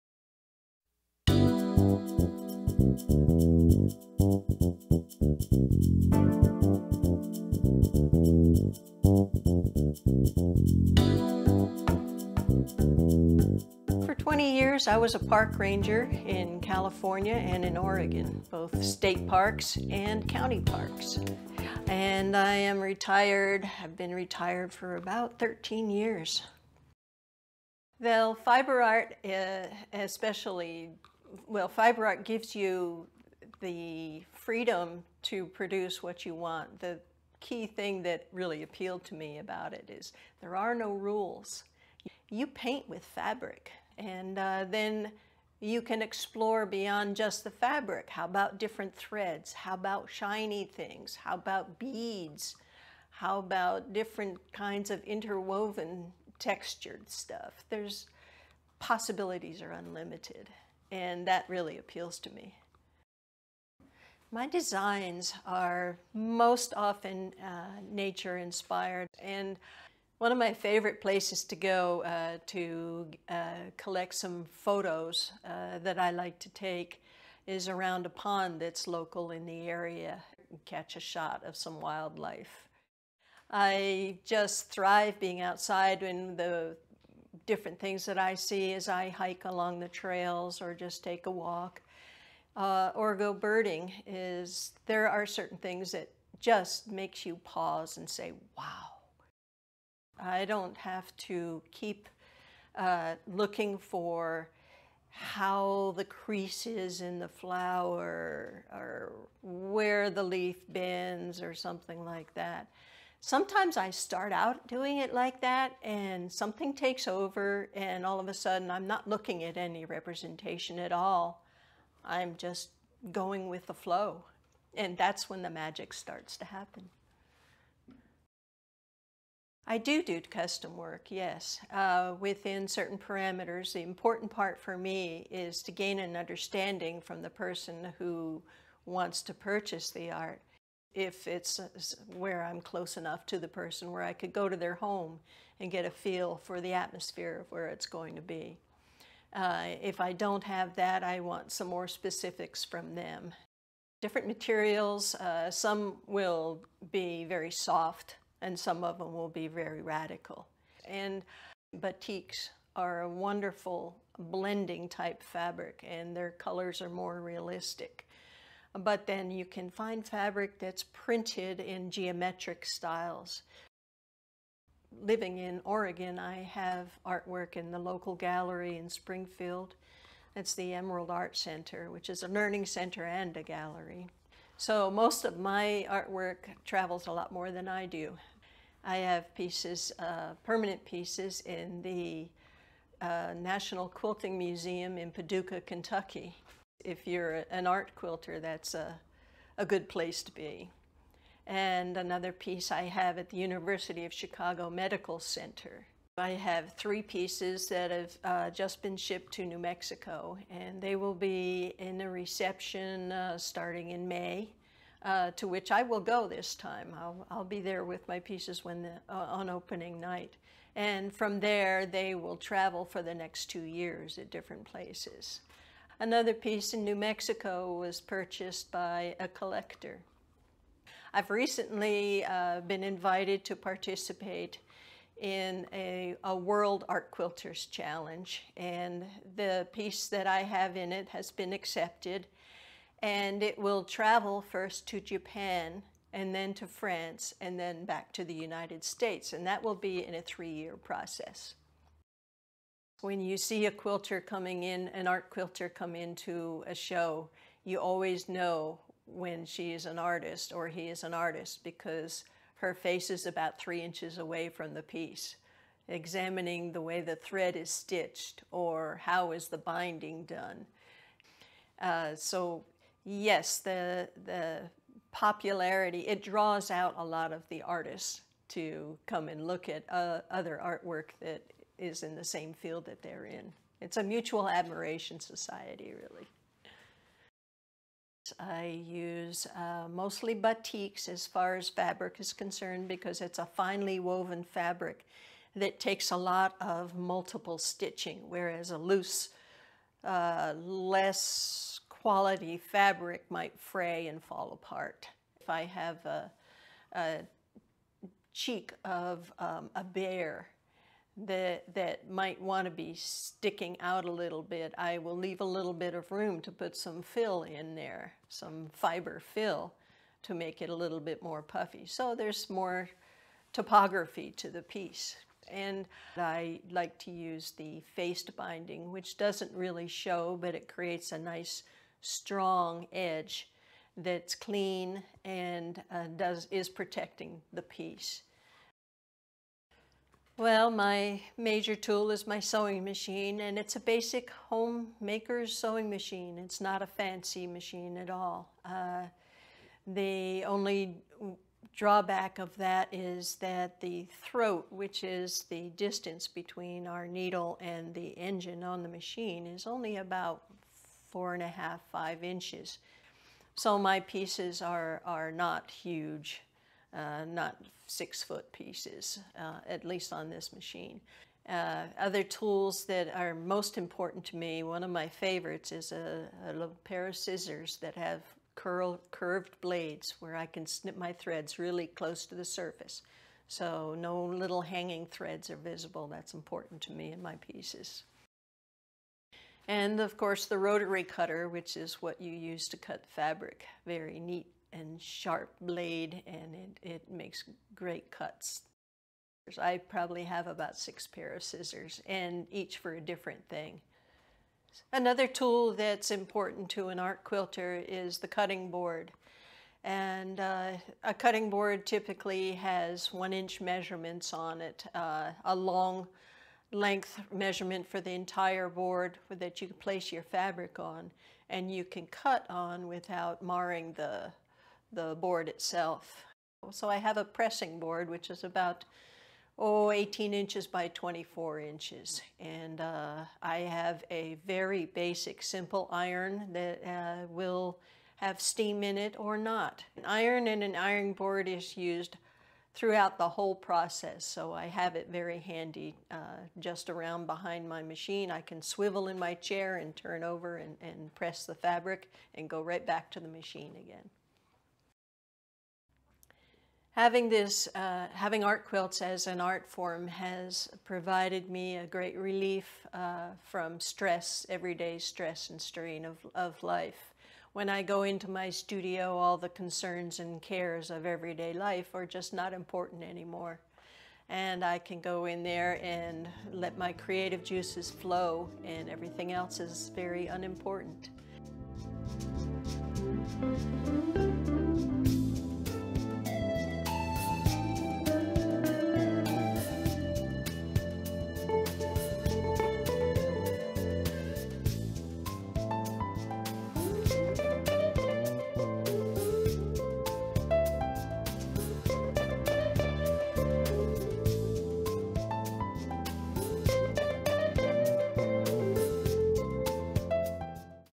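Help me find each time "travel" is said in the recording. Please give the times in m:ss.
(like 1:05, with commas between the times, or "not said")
3:06, 3:42, 4:03.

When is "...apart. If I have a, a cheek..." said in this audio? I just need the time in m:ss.
5:04.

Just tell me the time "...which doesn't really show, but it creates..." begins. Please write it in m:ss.
5:28.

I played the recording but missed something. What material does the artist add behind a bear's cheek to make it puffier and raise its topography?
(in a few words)
Fiber fill.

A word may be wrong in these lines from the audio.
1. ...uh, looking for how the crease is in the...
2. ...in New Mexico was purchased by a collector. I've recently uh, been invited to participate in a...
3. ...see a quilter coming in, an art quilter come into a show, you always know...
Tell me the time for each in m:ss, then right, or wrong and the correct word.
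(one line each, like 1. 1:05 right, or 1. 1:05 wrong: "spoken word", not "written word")
1. 1:42 right
2. 3:46 right
3. 4:13 right.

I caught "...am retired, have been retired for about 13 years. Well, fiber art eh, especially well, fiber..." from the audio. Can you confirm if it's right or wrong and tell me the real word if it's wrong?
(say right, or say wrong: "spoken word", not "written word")
right.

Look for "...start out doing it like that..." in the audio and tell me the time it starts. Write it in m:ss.
1:53.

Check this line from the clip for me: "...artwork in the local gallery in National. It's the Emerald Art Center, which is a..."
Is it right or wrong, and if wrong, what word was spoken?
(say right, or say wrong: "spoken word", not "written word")
wrong: "Springfield", not "National".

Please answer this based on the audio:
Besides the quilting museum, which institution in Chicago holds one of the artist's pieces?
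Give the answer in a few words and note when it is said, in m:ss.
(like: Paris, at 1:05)
University of Chicago Medical Center, at 3:23.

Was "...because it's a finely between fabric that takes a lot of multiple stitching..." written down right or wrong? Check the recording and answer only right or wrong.
wrong.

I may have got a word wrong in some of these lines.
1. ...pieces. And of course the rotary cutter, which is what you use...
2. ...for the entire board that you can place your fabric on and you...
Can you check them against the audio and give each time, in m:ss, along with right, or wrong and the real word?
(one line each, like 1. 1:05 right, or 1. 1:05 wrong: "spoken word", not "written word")
1. 6:27 right
2. 6:57 right.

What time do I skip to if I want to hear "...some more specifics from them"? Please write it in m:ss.
2:31.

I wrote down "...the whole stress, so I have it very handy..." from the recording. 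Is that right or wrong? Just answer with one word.
wrong.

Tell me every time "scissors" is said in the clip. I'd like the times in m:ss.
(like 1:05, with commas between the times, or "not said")
6:17, 6:41.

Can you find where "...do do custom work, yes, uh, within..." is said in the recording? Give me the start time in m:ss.
2:09.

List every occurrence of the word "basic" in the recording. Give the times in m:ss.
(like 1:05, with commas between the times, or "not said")
5:43, 7:14.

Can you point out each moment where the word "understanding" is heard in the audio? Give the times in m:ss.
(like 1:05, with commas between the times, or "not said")
2:16.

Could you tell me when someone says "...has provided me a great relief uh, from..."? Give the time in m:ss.
7:40.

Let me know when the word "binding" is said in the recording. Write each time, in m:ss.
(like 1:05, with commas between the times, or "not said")
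4:29, 5:28.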